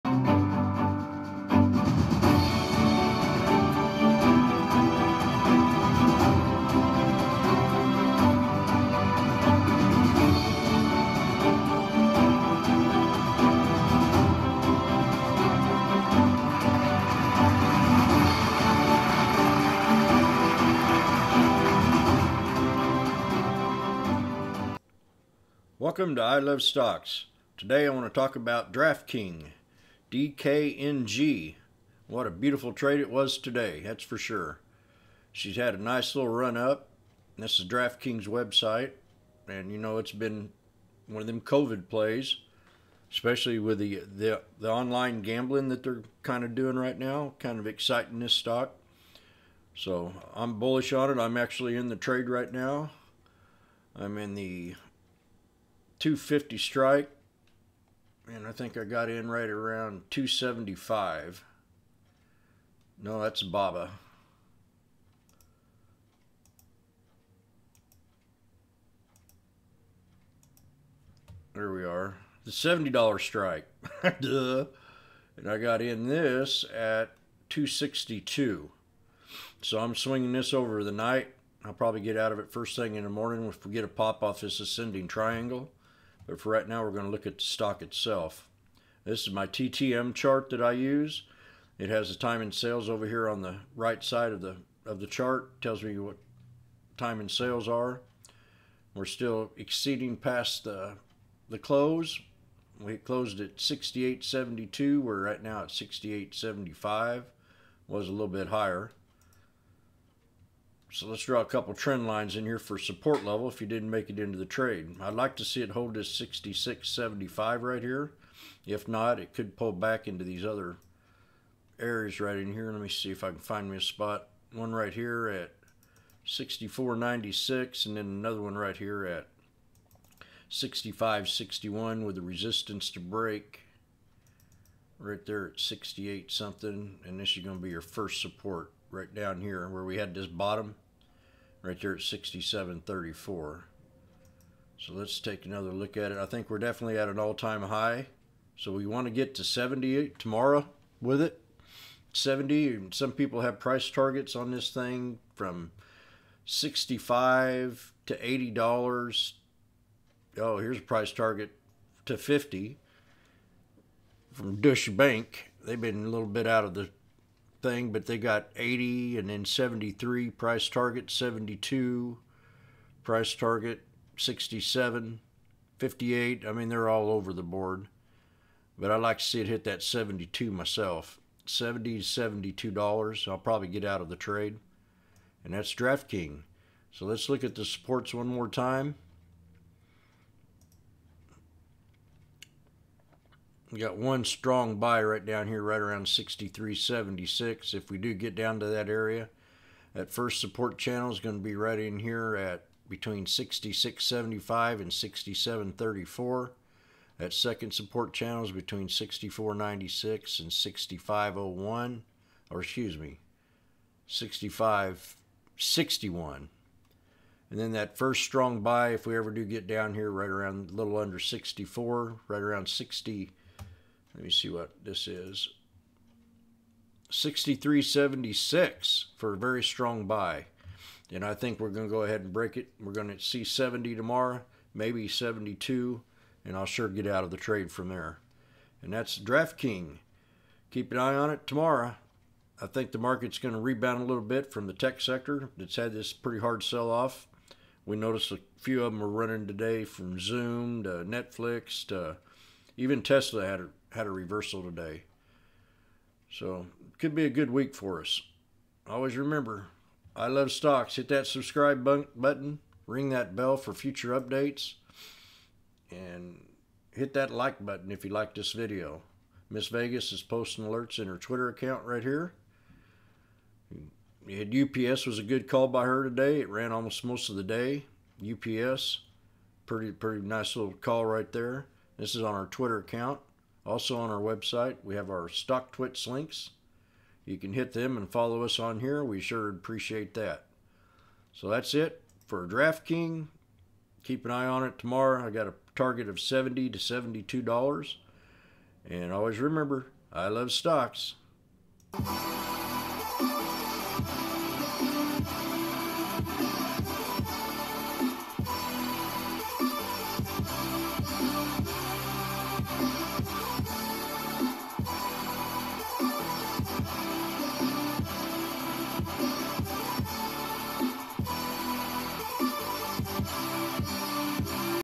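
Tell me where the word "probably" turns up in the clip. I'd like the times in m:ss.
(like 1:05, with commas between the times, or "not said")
1:21, 3:03.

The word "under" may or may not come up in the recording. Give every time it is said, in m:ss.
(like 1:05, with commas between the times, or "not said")
3:40.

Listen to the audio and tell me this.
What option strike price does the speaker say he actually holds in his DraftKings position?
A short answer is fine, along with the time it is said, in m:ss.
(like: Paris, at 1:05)
$70, at 1:12.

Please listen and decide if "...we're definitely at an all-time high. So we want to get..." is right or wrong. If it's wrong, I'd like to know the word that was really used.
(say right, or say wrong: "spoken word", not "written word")
right.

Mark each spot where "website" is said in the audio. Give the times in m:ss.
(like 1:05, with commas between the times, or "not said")
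0:38, 4:44.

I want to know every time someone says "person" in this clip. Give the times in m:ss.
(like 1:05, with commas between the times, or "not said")
not said.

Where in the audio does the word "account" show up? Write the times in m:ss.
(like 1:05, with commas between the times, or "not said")
4:31, 4:42.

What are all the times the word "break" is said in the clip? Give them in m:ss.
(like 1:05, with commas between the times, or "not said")
2:12, 3:52.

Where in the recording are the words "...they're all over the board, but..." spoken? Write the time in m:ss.
2:56.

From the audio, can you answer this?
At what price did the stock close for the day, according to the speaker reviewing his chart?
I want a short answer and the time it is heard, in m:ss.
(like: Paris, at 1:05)
68.72, at 1:43.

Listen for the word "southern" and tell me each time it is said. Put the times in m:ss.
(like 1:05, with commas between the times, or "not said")
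not said.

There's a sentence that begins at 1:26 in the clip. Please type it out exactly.
But for right now, we're going to look at the stock itself.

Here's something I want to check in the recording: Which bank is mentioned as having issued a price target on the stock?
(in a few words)
Deutsche Bank.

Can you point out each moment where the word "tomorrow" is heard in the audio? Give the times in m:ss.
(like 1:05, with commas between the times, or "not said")
2:30, 3:53, 4:01, 4:54.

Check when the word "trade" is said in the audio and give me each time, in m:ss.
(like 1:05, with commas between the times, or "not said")
0:32, 0:51, 1:54, 3:04, 3:57.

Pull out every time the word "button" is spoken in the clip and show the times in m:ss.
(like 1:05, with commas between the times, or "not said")
4:21, 4:27.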